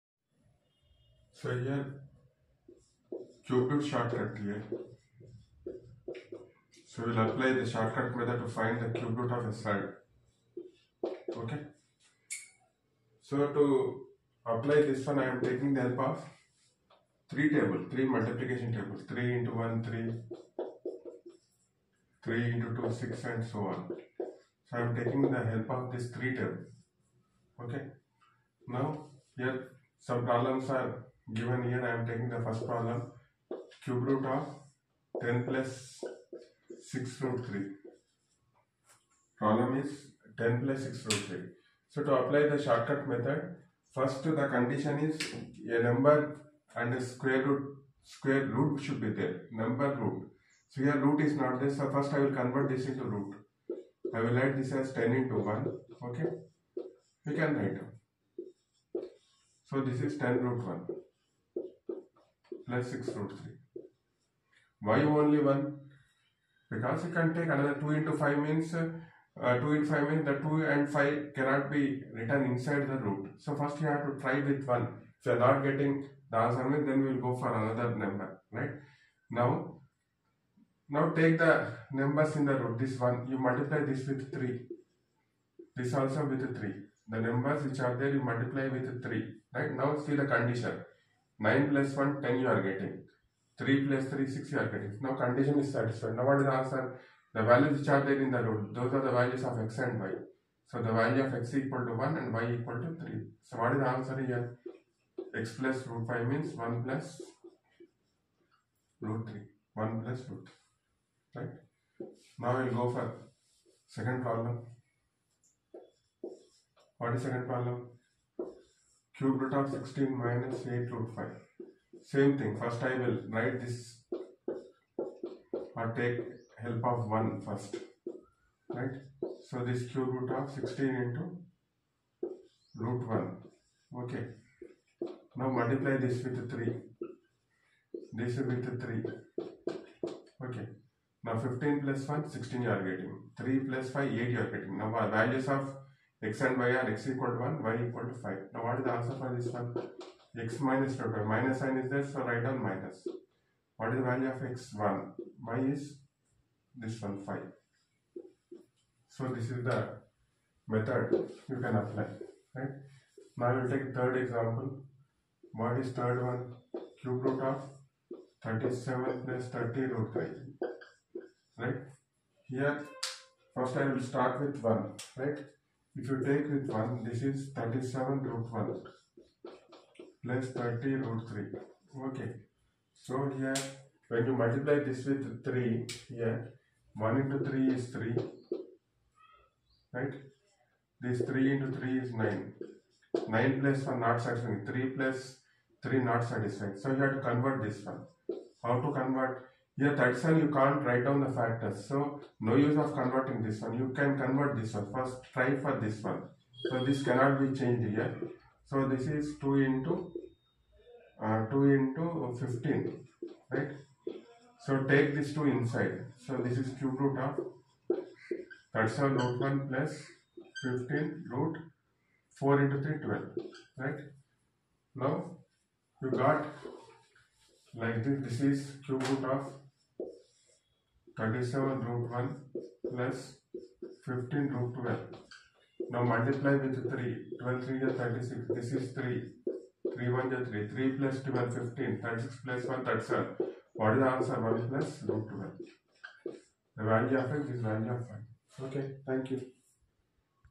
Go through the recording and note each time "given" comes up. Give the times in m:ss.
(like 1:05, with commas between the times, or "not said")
0:31.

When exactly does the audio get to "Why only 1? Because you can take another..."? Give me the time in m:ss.
1:04.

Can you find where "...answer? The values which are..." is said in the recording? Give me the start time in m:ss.
1:36.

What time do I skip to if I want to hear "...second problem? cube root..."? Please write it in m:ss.
1:57.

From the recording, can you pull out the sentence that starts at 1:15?
If you are not getting the answer means then we will go for another number.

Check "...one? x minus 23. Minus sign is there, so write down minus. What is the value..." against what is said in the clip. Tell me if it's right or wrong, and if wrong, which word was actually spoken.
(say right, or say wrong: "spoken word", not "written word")
wrong: "25", not "23".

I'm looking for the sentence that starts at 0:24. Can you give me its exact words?
So I am taking the help of this three table.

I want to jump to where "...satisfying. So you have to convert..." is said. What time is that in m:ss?
3:16.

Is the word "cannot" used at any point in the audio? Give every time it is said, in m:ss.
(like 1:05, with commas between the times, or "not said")
1:11, 3:27.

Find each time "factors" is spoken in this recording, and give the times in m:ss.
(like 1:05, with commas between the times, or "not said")
3:21.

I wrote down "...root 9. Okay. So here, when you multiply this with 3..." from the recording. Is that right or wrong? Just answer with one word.
wrong.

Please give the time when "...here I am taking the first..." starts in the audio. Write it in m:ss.
0:31.